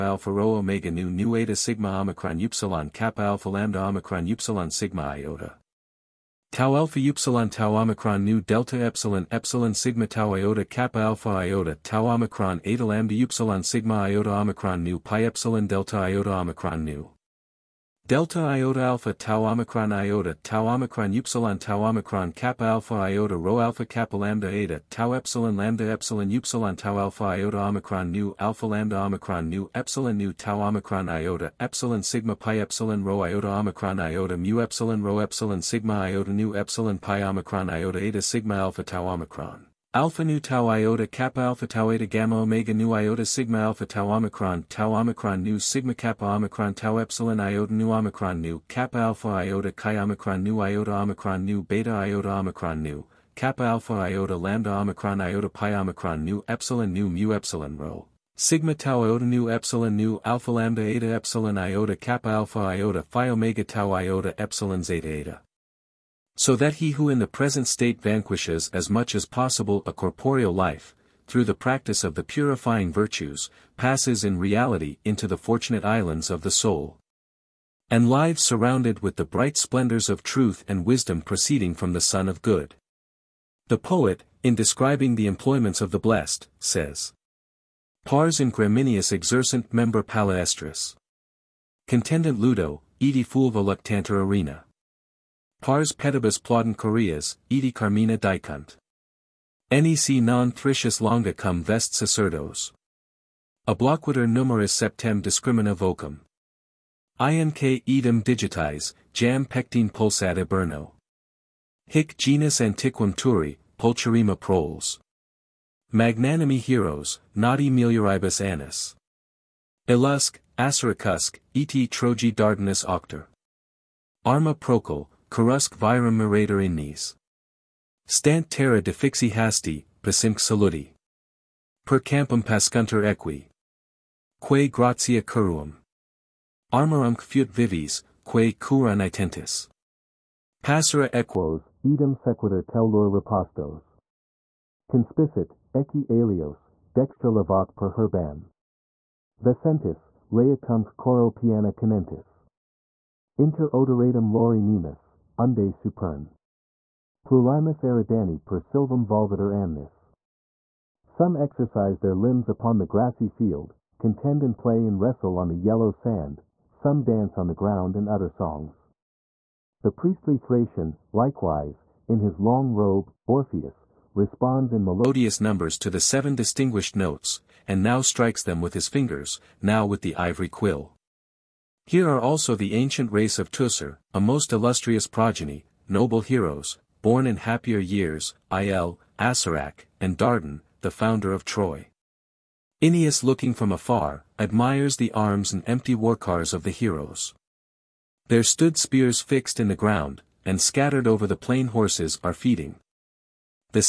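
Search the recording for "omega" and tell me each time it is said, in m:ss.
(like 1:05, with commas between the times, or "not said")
0:00, 0:42, 1:03.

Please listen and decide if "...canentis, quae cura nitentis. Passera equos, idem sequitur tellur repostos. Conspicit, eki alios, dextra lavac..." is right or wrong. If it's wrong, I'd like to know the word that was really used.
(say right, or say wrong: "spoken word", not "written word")
wrong: "vivis", not "canentis".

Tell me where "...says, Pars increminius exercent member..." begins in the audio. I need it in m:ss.
1:26.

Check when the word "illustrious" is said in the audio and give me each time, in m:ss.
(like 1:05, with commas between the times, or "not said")
3:04.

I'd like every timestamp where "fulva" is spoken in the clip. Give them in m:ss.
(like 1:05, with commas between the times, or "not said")
1:33.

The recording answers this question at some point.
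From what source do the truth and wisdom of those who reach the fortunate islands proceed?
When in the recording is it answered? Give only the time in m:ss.
1:22.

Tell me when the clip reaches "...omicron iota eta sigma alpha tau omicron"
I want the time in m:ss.
0:37.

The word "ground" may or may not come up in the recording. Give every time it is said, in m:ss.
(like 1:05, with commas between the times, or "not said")
2:47, 3:19.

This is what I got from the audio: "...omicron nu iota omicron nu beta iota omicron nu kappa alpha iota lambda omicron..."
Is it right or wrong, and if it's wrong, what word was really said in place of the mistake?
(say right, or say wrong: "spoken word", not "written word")
right.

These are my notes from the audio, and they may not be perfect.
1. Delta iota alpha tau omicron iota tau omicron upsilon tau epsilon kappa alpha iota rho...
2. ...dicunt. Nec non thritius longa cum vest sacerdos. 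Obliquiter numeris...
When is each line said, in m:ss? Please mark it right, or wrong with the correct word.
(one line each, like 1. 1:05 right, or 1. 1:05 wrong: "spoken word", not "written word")
1. 0:18 wrong: "omicron", not "epsilon"
2. 1:38 right.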